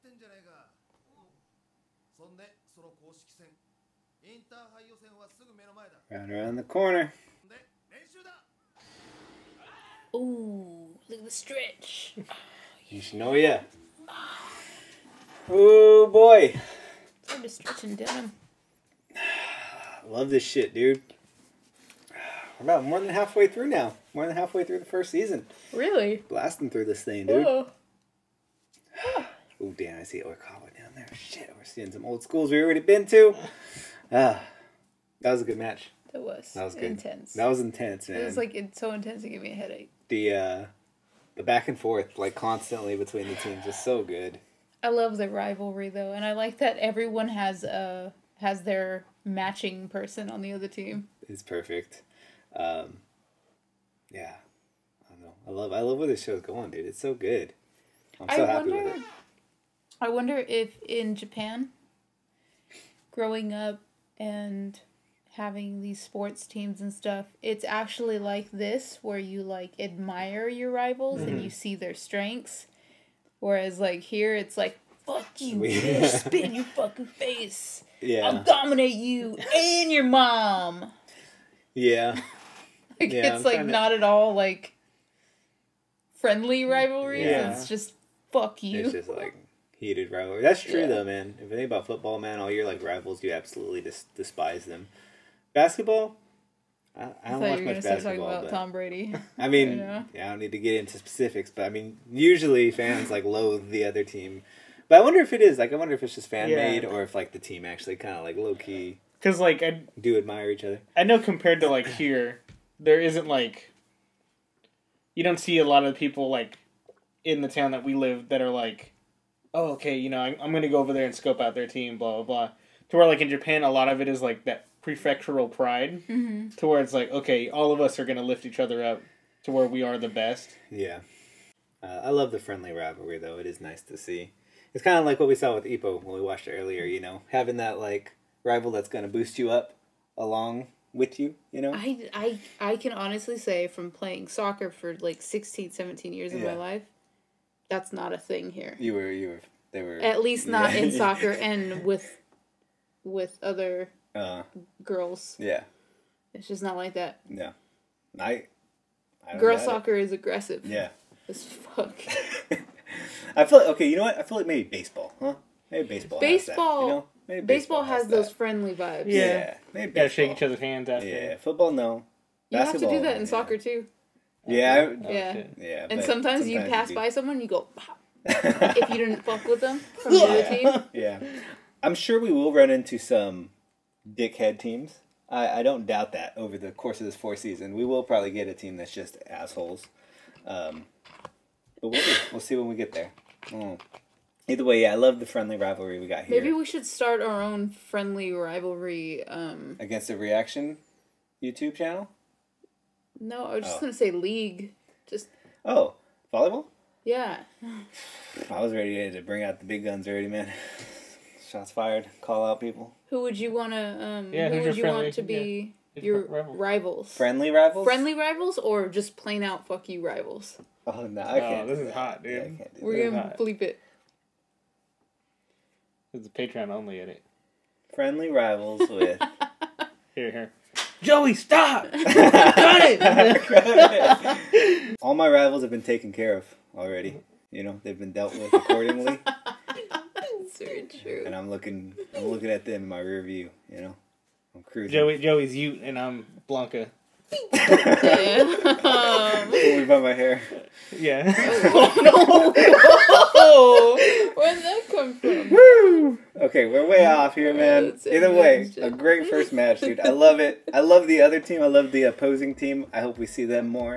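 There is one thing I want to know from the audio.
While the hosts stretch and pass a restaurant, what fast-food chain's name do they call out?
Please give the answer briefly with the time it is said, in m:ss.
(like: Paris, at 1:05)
Yoshinoya, at 0:12.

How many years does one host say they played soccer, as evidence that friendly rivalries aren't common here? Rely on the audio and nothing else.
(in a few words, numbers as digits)
16 17 years.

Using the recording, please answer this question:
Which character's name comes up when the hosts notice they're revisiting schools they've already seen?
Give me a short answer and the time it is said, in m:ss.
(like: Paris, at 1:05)
Oikawa, at 0:30.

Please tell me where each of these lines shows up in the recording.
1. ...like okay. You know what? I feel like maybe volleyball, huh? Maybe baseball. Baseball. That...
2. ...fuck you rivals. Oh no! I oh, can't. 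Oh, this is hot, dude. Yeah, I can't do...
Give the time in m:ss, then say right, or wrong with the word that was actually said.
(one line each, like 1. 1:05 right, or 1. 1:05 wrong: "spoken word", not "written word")
1. 2:43 wrong: "baseball", not "volleyball"
2. 3:39 right.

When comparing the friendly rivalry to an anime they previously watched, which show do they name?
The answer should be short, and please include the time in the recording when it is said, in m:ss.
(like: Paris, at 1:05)
Ippo, at 2:15.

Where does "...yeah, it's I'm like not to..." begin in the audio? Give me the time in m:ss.
1:23.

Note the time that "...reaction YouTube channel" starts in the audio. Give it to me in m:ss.
3:20.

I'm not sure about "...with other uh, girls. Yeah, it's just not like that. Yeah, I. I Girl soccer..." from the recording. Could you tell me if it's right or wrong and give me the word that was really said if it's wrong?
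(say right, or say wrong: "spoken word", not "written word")
right.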